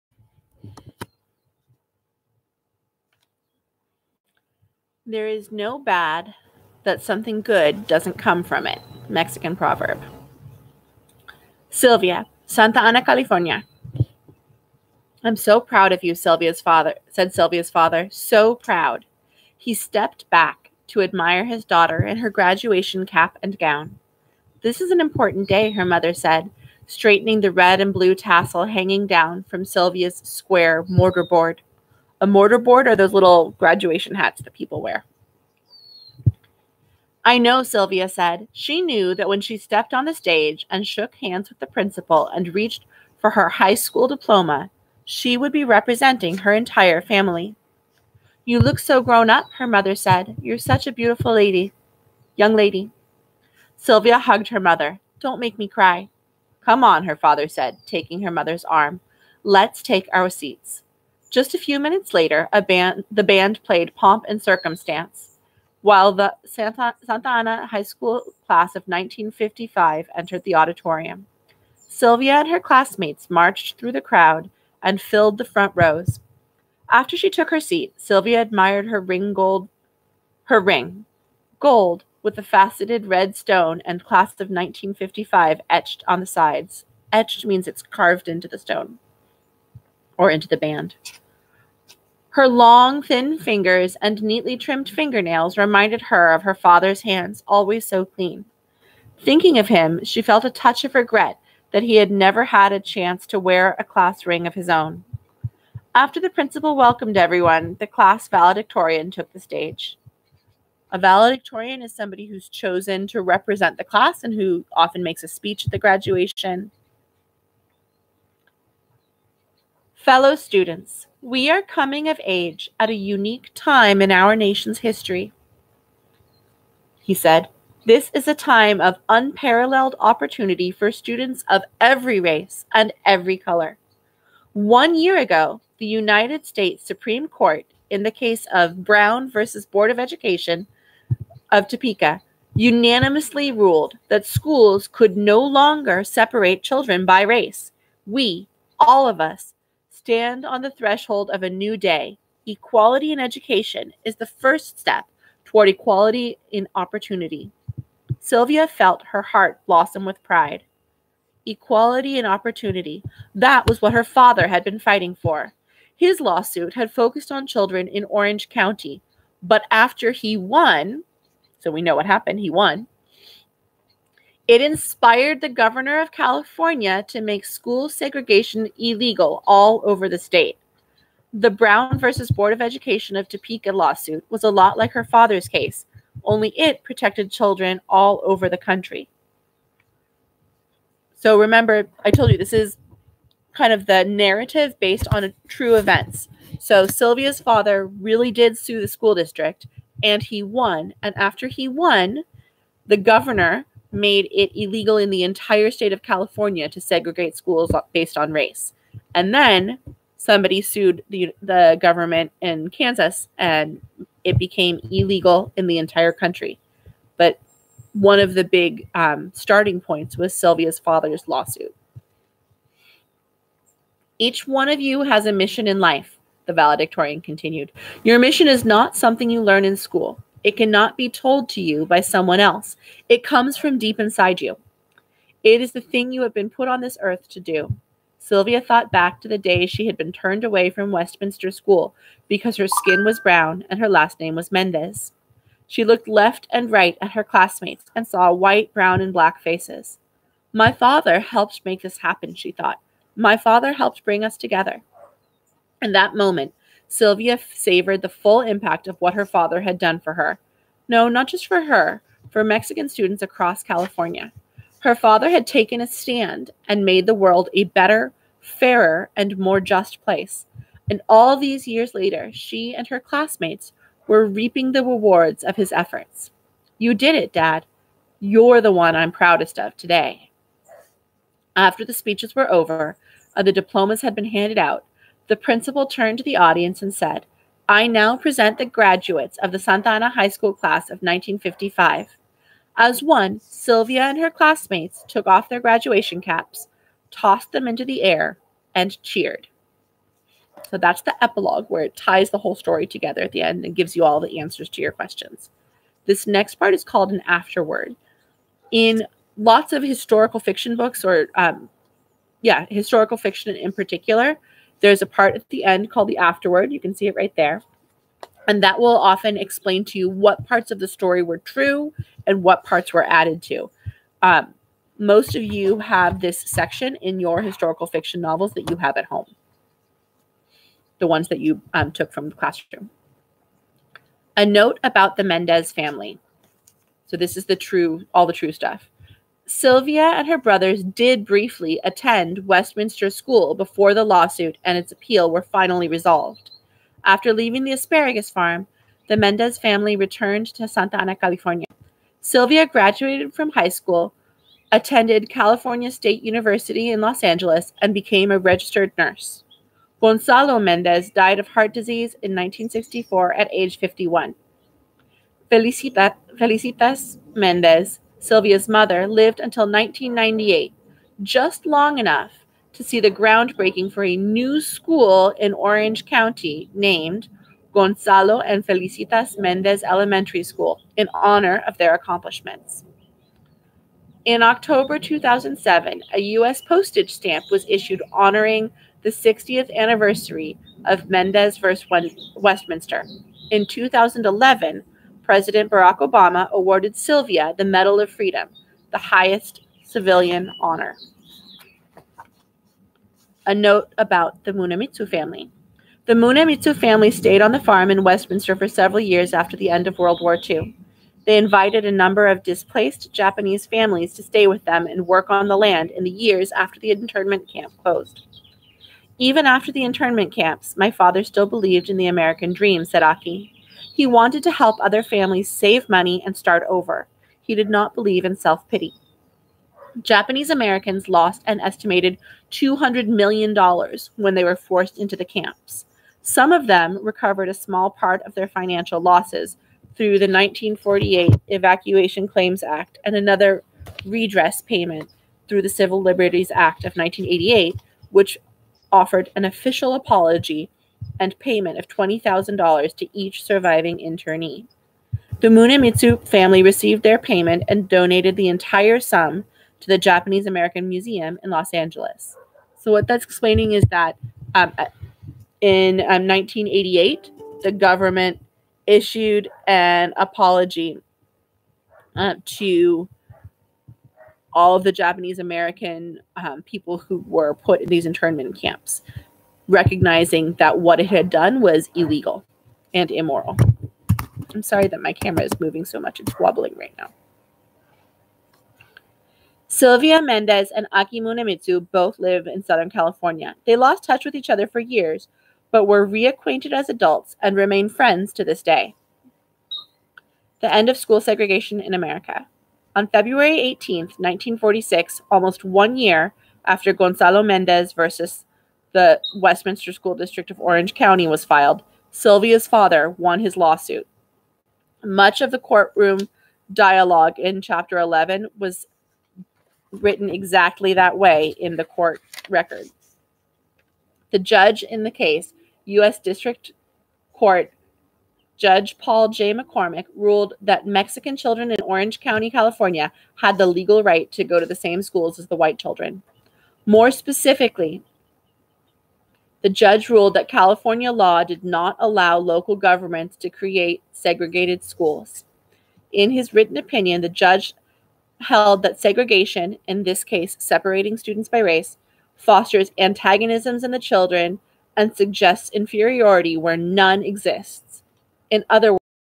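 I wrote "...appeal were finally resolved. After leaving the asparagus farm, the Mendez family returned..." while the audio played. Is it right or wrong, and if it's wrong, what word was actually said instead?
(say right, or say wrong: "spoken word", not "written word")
right.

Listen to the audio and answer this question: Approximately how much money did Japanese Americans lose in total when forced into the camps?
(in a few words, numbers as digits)
$200 million.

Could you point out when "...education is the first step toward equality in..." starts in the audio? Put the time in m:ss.
2:33.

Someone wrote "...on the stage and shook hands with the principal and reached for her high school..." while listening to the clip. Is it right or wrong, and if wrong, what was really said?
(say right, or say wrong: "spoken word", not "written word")
right.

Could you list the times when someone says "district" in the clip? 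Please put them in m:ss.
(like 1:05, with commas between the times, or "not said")
3:19, 8:30, 8:46.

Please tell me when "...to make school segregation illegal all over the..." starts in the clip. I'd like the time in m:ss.
2:57.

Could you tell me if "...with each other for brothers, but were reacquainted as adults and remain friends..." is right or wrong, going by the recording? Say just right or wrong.
wrong.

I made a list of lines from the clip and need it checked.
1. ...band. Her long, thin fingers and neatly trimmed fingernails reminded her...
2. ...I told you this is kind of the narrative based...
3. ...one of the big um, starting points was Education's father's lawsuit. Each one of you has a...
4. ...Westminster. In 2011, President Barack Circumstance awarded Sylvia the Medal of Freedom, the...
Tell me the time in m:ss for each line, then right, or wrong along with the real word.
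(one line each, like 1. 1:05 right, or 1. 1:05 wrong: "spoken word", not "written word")
1. 1:30 right
2. 3:12 right
3. 3:37 wrong: "Sylvia", not "Education"
4. 6:32 wrong: "Obama", not "Circumstance".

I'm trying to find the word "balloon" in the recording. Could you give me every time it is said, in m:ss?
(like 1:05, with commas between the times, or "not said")
not said.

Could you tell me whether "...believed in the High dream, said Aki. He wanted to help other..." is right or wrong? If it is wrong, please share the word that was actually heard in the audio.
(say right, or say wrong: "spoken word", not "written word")
wrong: "American", not "High".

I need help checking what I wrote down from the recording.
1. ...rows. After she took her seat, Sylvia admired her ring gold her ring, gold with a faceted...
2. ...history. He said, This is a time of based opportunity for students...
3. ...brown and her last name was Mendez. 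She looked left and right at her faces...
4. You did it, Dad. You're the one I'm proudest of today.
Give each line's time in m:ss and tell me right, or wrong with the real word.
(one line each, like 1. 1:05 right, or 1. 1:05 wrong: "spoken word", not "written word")
1. 1:15 right
2. 2:04 wrong: "unparalleled", not "based"
3. 4:03 wrong: "classmates", not "faces"
4. 4:36 right.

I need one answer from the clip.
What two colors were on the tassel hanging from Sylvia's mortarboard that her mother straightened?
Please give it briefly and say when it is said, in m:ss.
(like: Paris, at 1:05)
red and blue, at 0:27.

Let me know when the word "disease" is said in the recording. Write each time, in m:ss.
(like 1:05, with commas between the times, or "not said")
6:01.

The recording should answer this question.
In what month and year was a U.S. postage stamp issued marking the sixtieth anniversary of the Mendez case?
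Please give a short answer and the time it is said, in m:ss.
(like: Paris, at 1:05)
October 2007, at 6:24.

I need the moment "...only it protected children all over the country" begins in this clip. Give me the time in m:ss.
3:06.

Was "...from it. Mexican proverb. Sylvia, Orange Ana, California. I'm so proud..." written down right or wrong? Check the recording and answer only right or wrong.
wrong.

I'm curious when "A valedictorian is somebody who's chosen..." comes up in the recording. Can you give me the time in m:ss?
1:50.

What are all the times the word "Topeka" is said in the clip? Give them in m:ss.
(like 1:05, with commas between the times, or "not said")
2:21, 3:03.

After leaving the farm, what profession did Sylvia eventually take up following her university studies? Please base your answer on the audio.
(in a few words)
registered nurse.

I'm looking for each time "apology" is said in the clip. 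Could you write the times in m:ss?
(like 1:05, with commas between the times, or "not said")
7:29, 7:50.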